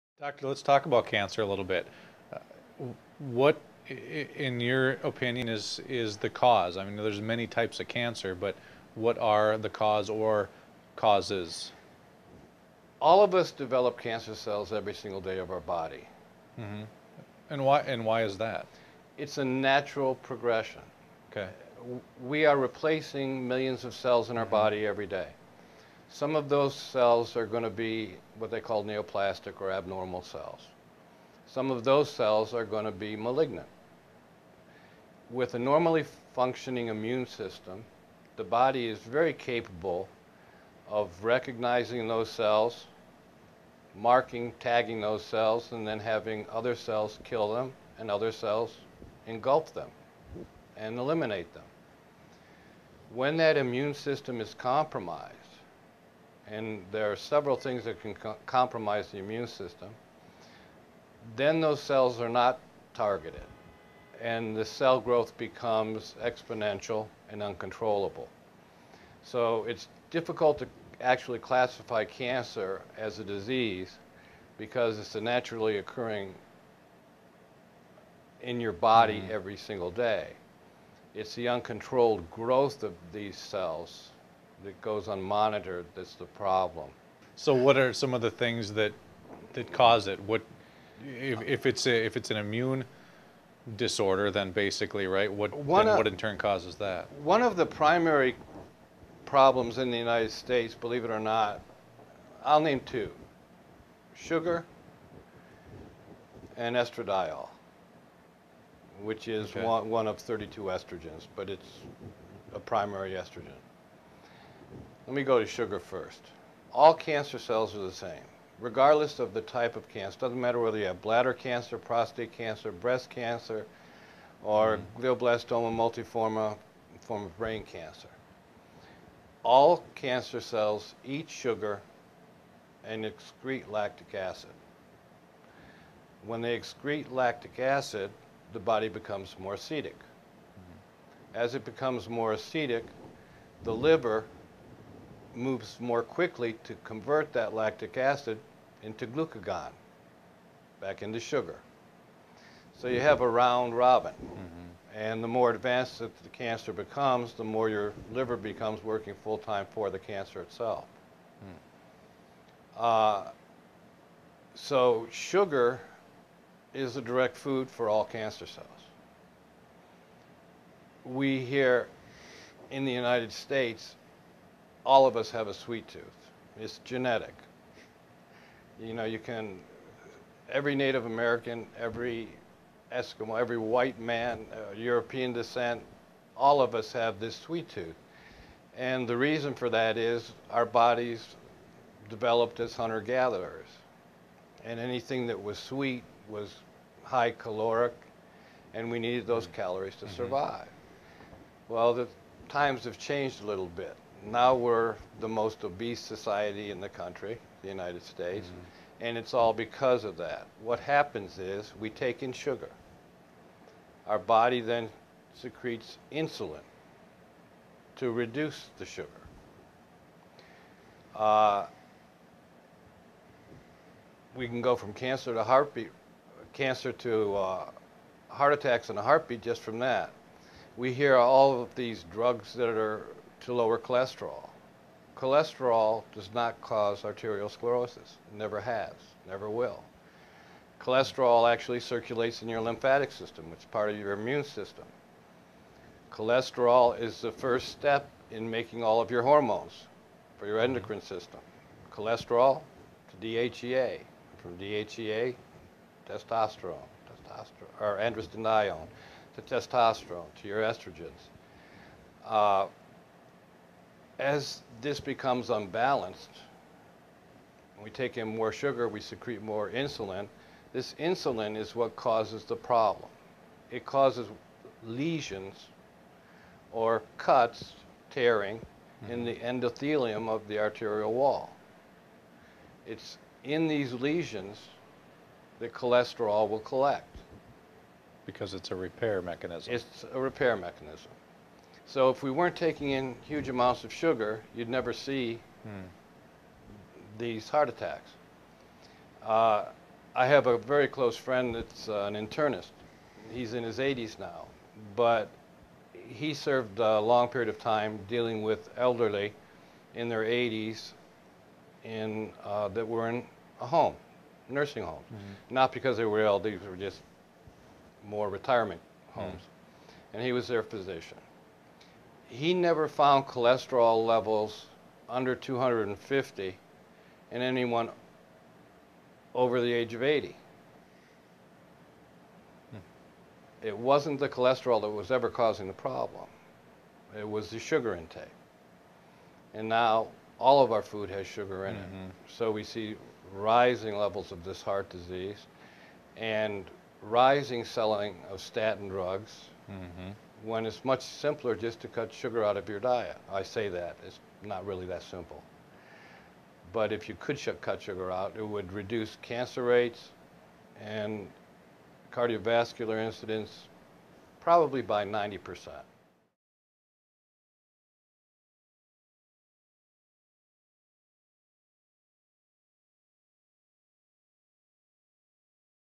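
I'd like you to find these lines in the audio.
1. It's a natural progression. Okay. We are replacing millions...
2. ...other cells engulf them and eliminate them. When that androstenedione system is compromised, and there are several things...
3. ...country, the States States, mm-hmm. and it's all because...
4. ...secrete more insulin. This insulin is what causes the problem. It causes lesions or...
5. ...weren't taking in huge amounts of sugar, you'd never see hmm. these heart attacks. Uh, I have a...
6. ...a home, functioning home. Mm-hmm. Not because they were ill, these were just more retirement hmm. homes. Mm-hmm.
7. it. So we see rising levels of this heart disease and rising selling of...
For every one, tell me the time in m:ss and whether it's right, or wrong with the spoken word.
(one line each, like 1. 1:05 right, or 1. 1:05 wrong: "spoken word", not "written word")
1. 0:19 right
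2. 0:48 wrong: "immune", not "androstenedione"
3. 3:26 wrong: "United", not "States"
4. 4:29 right
5. 4:52 right
6. 5:13 wrong: "nursing", not "functioning"
7. 5:42 right.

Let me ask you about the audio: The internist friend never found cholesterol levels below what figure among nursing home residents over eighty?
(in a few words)
250.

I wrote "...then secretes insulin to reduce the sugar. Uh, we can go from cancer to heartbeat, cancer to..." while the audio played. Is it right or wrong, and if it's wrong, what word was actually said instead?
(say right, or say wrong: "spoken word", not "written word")
right.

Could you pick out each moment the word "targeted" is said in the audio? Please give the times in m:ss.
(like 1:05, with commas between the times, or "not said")
1:02.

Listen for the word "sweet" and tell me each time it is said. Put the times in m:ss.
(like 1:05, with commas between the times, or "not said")
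2:55, 3:07, 3:15.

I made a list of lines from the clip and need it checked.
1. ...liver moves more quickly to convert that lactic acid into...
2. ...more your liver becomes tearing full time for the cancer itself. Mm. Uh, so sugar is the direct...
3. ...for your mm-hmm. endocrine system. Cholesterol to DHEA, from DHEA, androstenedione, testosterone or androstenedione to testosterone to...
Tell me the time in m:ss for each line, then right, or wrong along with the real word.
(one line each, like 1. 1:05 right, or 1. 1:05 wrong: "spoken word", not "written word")
1. 2:23 right
2. 2:37 wrong: "working", not "tearing"
3. 4:10 wrong: "testosterone", not "androstenedione".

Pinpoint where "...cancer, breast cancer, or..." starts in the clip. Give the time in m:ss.
2:02.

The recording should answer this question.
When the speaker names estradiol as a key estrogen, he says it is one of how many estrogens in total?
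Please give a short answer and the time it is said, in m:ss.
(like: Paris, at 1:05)
32, at 1:50.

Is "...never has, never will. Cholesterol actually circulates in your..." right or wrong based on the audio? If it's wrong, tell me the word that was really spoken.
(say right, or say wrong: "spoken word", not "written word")
right.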